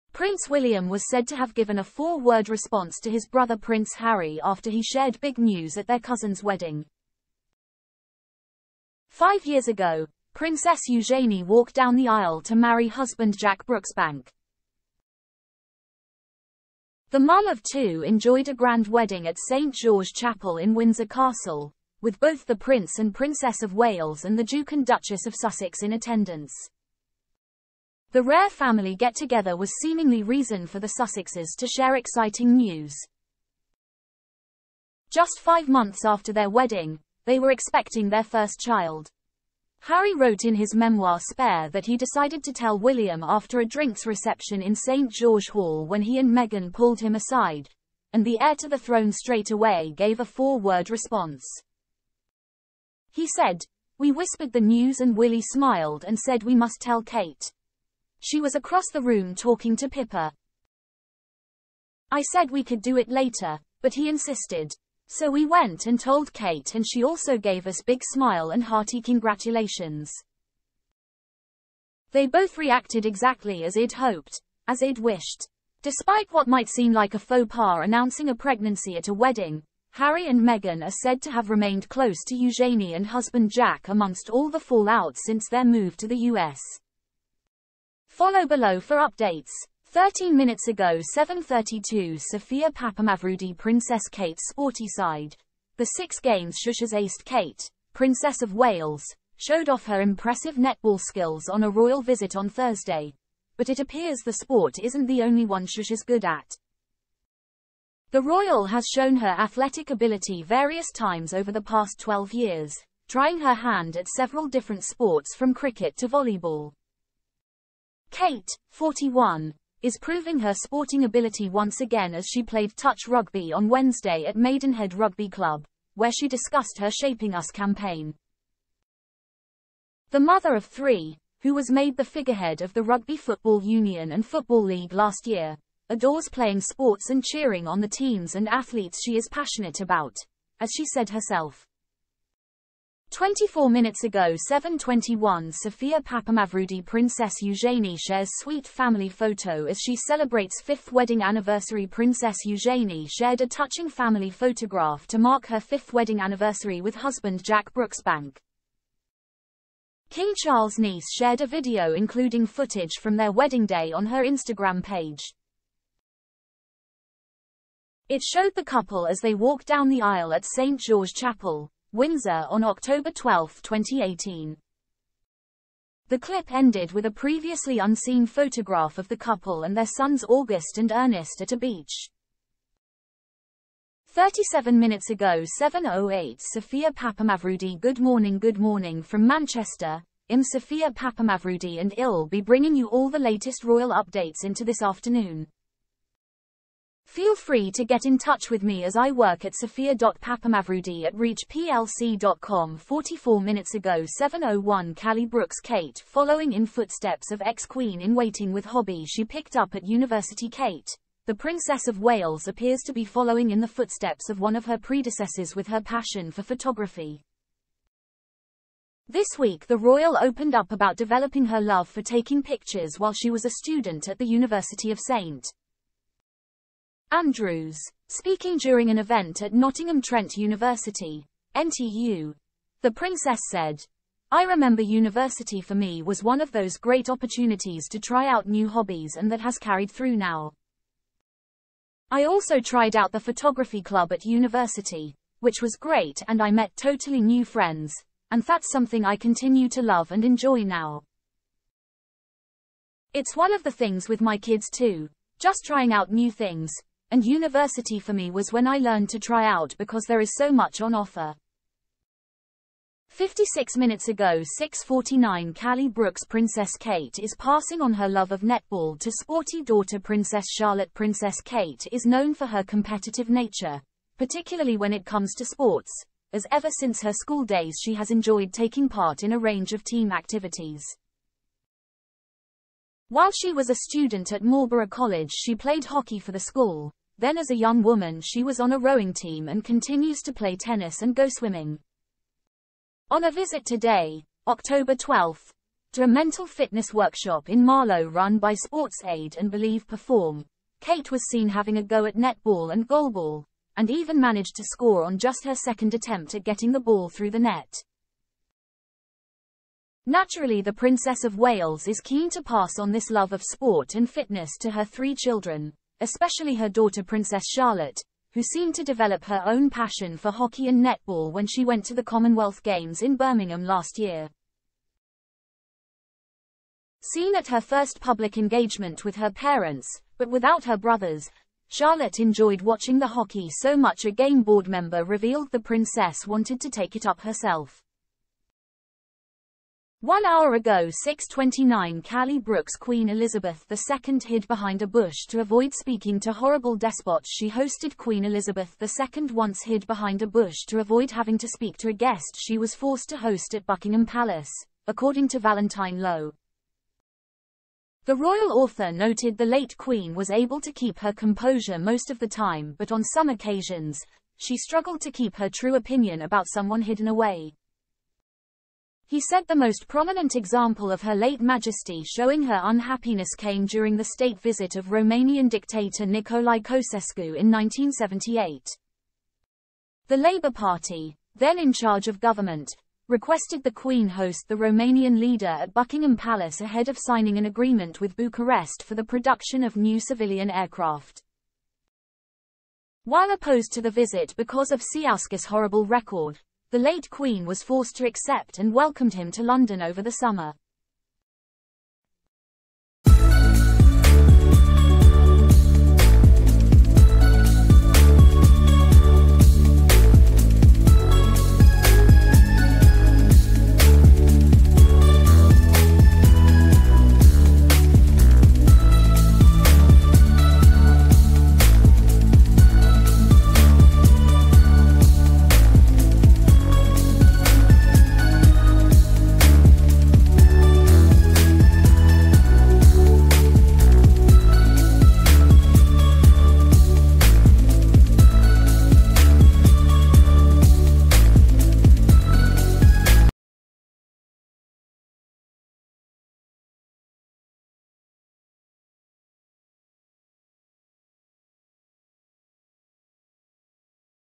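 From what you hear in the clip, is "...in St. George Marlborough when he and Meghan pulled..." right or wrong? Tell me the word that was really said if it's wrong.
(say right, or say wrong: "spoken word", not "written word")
wrong: "Hall", not "Marlborough".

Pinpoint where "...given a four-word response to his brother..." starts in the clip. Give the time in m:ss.
0:01.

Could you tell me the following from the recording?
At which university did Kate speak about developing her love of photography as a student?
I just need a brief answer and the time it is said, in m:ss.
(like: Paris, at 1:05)
Nottingham Trent University, at 3:49.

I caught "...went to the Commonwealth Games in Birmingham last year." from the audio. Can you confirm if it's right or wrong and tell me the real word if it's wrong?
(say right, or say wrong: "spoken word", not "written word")
right.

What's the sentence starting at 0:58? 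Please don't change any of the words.
She was across the room talking to Pippa.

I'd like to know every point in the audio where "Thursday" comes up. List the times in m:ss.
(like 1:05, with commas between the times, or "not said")
1:42.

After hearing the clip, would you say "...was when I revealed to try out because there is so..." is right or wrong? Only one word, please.
wrong.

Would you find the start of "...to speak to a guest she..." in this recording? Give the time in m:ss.
5:51.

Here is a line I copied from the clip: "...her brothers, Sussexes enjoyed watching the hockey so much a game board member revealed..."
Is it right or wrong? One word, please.
wrong.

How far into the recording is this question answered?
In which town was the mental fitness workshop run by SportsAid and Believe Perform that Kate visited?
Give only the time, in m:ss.
4:57.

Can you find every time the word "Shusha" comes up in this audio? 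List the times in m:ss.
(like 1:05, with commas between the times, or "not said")
1:36, 1:45.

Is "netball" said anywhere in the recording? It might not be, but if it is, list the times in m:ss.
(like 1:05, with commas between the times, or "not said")
1:40, 4:28, 5:02, 5:20.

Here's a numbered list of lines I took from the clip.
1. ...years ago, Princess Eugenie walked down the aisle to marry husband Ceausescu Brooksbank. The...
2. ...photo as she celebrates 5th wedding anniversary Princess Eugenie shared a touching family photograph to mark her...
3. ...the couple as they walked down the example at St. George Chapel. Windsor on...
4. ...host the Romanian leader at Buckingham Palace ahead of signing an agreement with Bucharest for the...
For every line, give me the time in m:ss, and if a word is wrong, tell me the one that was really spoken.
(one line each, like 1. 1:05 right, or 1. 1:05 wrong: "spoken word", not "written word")
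1. 0:09 wrong: "Jack", not "Ceausescu"
2. 2:29 right
3. 2:48 wrong: "aisle", not "example"
4. 6:24 right.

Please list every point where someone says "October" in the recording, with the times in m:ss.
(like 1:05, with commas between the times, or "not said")
2:52, 4:54.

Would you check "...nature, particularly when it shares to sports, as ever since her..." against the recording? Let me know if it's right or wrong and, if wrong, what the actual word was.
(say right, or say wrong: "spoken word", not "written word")
wrong: "comes", not "shares".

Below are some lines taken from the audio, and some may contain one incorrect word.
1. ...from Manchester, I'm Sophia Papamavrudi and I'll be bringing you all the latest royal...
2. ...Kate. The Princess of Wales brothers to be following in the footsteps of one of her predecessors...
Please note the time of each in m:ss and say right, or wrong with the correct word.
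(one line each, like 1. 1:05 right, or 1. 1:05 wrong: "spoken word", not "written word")
1. 3:09 right
2. 3:30 wrong: "appears", not "brothers".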